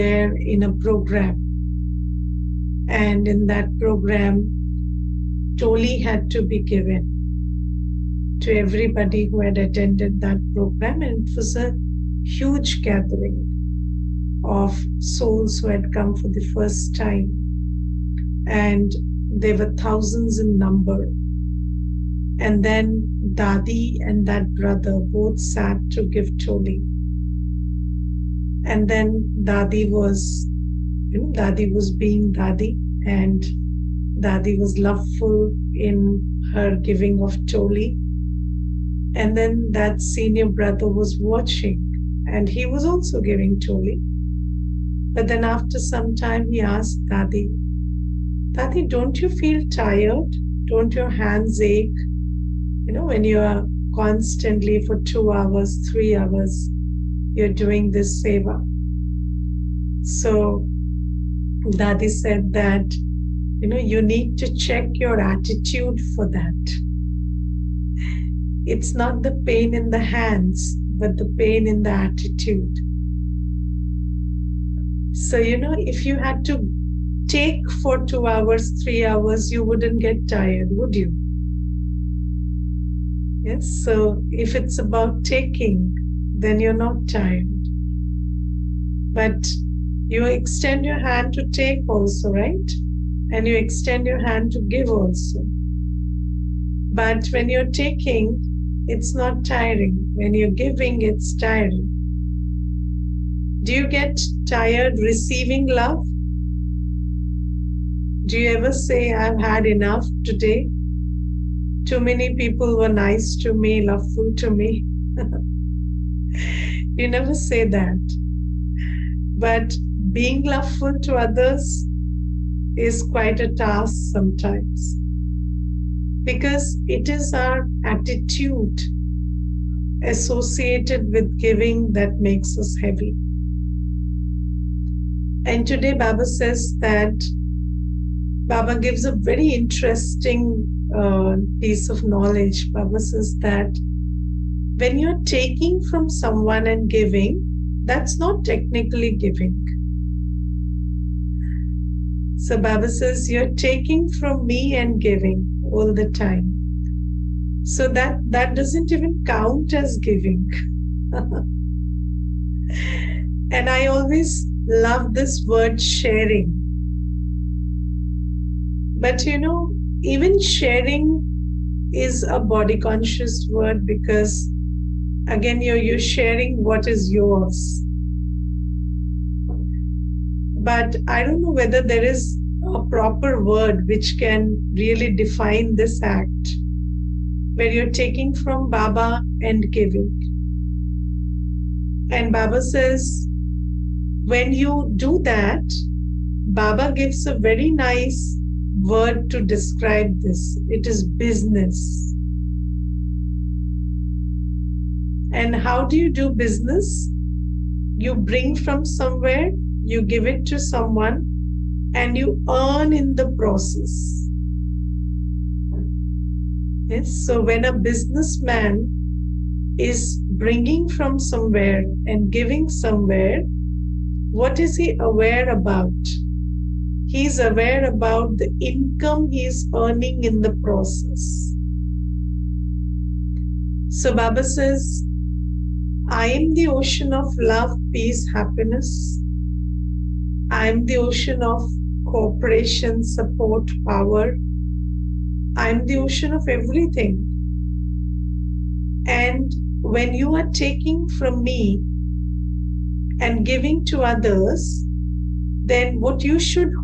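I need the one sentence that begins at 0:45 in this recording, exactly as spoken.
But then after some time, he asked Dadi, Dadi, don't you feel tired?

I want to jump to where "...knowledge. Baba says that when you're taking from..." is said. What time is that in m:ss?
2:22.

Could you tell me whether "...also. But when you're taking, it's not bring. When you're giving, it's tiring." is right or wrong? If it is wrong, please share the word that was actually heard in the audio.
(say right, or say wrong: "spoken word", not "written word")
wrong: "tiring", not "bring".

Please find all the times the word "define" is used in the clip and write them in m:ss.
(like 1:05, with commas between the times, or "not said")
3:05.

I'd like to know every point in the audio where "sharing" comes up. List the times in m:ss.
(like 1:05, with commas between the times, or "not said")
2:45, 2:50, 2:55.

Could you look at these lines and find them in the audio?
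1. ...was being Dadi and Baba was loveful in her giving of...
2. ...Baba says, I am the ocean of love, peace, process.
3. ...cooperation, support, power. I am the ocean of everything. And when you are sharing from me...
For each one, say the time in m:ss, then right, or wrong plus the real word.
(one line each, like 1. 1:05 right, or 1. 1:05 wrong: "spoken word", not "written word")
1. 0:31 wrong: "Dadi", not "Baba"
2. 3:54 wrong: "happiness", not "process"
3. 4:02 wrong: "taking", not "sharing".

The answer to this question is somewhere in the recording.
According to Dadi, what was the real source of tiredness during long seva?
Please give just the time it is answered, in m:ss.
1:11.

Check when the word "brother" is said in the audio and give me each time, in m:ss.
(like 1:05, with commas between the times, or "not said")
0:24, 0:40.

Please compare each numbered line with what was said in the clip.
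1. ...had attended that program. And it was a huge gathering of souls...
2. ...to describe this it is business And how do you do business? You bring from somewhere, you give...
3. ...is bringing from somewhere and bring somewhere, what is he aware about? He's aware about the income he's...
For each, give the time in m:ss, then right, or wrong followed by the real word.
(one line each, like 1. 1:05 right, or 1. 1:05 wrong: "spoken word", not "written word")
1. 0:09 right
2. 3:19 right
3. 3:39 wrong: "giving", not "bring".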